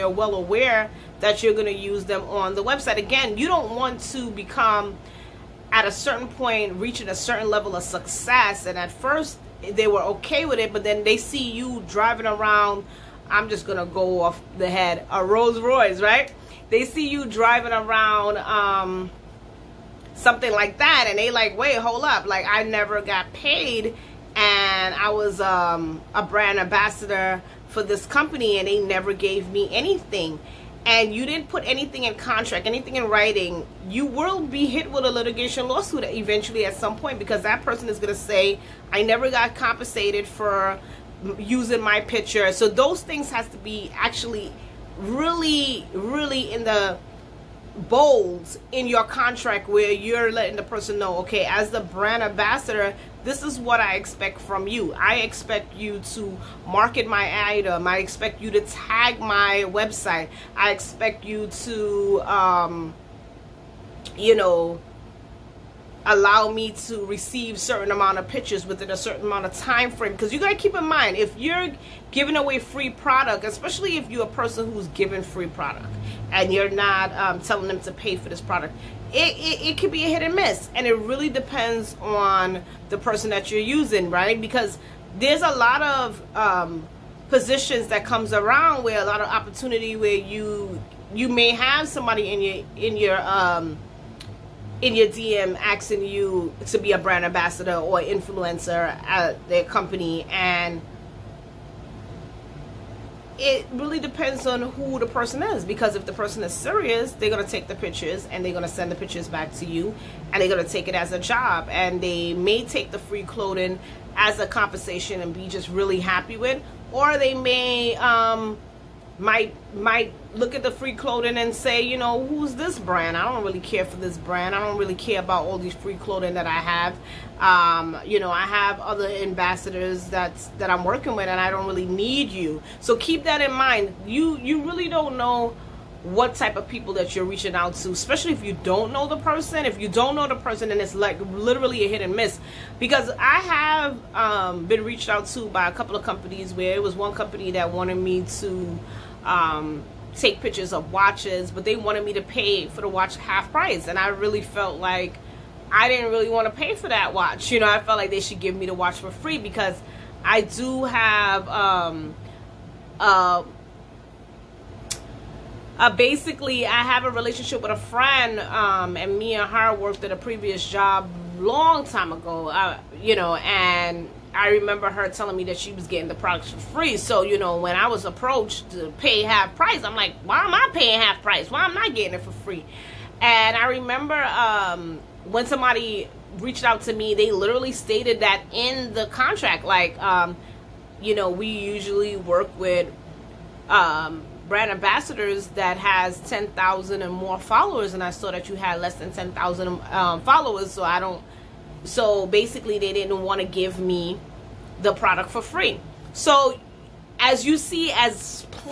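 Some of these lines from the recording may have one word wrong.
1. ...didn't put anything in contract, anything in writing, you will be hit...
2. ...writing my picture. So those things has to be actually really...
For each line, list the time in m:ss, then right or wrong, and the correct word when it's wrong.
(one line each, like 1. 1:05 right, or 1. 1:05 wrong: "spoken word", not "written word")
1. 0:31 right
2. 0:41 wrong: "using", not "writing".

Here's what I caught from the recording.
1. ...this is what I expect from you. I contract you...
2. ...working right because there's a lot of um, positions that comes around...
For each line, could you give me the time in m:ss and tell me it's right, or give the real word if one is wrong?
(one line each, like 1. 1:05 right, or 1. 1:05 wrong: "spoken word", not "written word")
1. 0:53 wrong: "expect", not "contract"
2. 1:23 wrong: "using", not "working".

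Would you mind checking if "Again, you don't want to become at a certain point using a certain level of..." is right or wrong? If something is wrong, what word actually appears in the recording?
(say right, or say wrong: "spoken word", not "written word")
wrong: "reaching", not "using".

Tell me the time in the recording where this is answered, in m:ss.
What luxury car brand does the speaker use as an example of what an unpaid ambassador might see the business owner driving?
0:15.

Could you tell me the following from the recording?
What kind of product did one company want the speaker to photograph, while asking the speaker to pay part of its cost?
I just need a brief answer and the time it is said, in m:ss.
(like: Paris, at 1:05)
Watches, at 2:30.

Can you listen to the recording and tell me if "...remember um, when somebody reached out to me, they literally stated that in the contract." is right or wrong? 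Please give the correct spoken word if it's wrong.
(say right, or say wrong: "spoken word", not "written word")
right.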